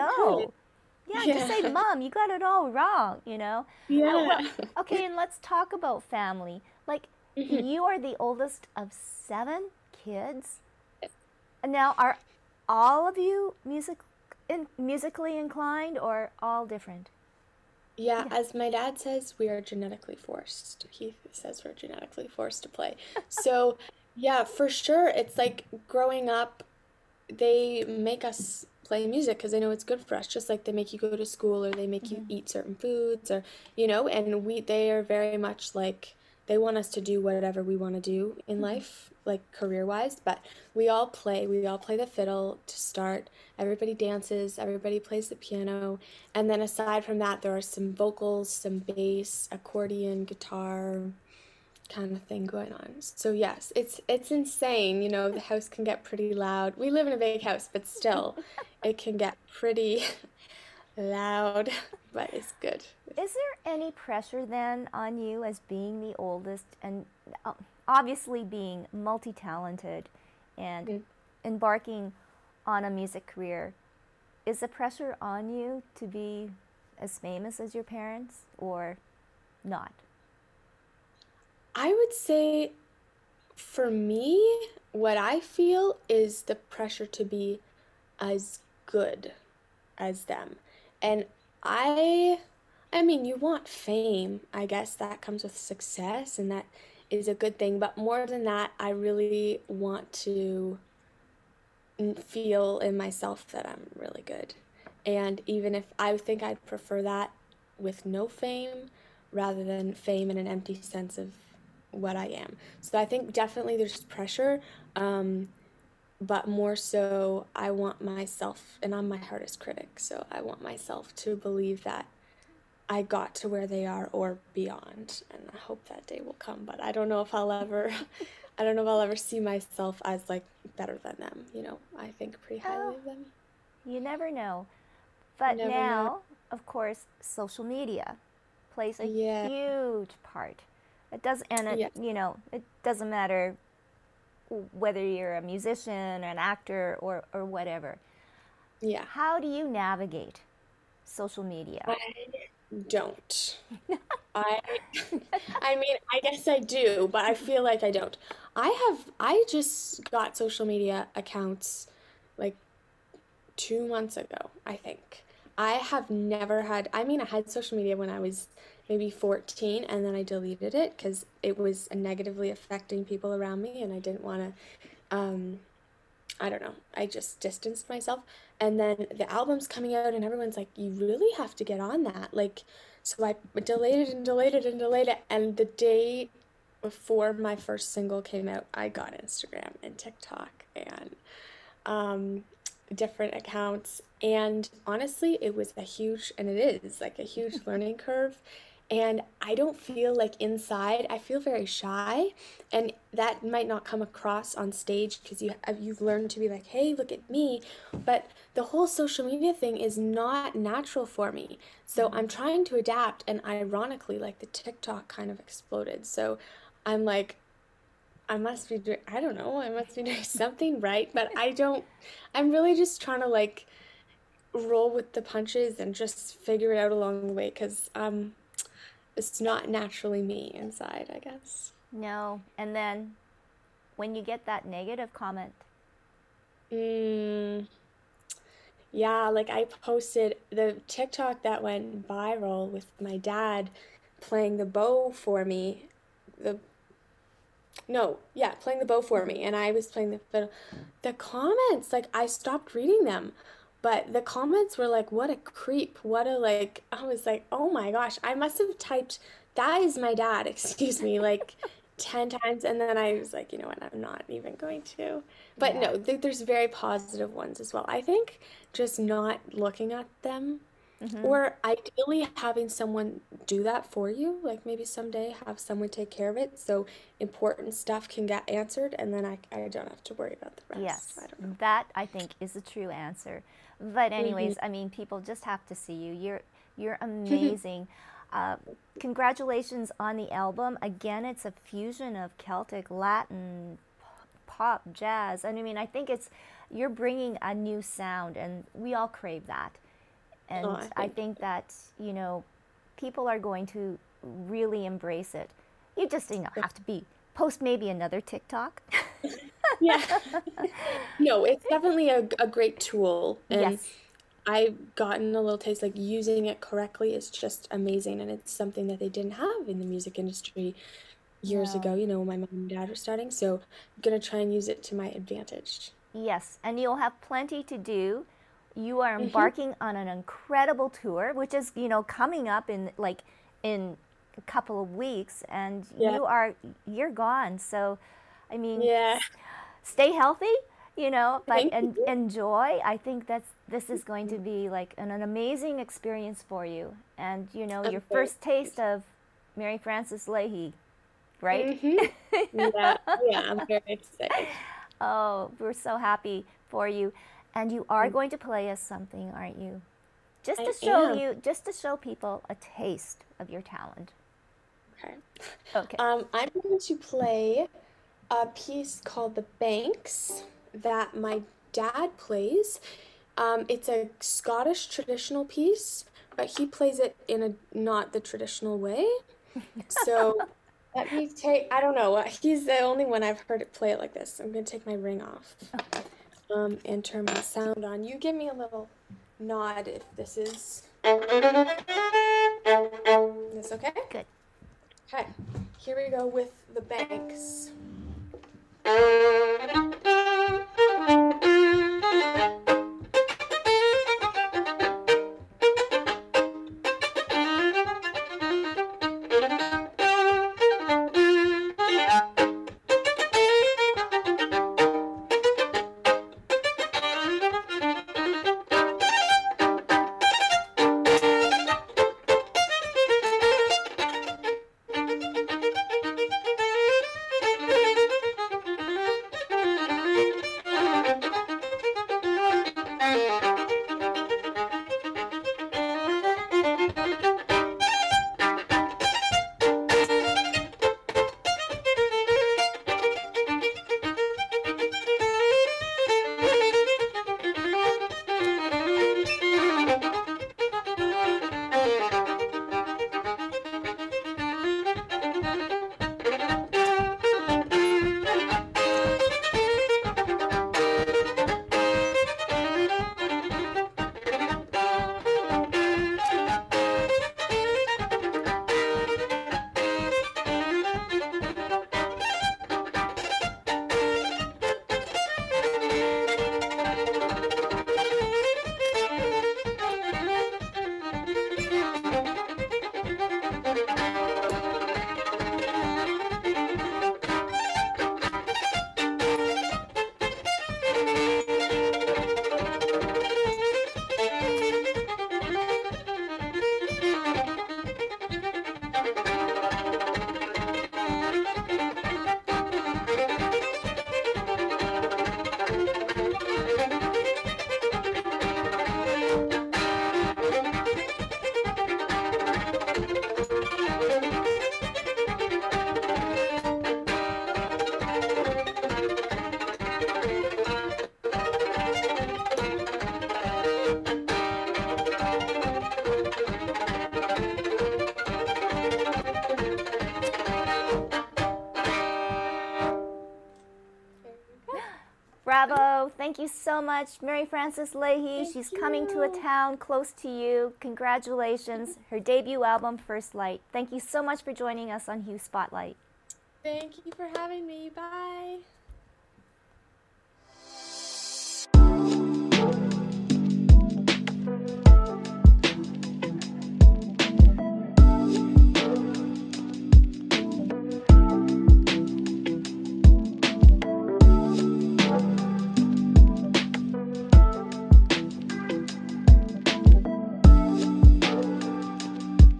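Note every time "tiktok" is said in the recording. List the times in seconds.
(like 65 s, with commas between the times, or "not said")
189 s, 214 s, 240 s, 308 s.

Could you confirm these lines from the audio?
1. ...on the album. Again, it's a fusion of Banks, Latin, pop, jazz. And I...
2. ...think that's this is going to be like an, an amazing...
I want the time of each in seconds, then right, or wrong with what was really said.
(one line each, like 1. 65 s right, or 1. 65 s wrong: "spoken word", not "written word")
1. 289 s wrong: "Celtic", not "Banks"
2. 342 s right.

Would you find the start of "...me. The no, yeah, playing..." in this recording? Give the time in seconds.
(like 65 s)
245 s.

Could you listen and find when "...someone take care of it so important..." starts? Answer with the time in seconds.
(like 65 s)
275 s.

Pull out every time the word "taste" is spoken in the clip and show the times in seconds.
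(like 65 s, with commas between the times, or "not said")
315 s, 348 s, 362 s.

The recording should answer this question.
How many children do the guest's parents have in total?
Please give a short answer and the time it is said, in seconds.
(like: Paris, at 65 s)
7, at 9 s.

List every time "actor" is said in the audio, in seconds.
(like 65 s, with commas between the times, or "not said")
146 s.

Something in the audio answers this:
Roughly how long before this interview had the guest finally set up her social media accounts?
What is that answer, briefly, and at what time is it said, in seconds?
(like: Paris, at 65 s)
2 months ago, at 163 s.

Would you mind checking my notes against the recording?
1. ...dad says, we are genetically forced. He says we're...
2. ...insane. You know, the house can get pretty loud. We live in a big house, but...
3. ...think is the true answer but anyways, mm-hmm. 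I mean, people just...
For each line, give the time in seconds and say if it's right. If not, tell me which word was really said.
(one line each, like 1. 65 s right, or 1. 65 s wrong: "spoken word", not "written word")
1. 18 s right
2. 54 s right
3. 282 s right.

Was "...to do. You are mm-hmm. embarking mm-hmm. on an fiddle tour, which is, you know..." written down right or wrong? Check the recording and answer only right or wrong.
wrong.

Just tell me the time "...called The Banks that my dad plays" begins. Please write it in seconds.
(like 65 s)
369 s.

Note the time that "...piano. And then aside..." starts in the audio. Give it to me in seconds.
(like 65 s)
45 s.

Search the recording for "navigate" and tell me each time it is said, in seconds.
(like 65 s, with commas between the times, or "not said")
149 s.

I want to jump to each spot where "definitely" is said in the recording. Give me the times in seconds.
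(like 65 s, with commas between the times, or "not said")
113 s, 311 s.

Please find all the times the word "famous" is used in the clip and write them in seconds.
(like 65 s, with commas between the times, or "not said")
77 s.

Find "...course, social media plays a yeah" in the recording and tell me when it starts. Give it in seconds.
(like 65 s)
136 s.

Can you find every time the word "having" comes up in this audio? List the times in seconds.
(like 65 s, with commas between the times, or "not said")
272 s, 547 s.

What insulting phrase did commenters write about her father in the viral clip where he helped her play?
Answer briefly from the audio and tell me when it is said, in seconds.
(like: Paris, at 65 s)
What a creep, at 255 s.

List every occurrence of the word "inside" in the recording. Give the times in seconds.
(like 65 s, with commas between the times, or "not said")
200 s, 230 s.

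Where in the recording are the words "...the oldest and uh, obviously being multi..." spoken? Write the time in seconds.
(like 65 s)
66 s.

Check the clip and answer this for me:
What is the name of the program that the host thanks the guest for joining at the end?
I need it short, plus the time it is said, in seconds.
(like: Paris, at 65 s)
Hue Spotlight, at 545 s.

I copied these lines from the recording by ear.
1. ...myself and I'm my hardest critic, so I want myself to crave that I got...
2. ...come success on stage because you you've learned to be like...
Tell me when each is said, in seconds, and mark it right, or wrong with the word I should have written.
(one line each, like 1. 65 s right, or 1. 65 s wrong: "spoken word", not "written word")
1. 118 s wrong: "believe", not "crave"
2. 203 s wrong: "across", not "success".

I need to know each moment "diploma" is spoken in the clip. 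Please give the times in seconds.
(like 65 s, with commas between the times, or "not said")
not said.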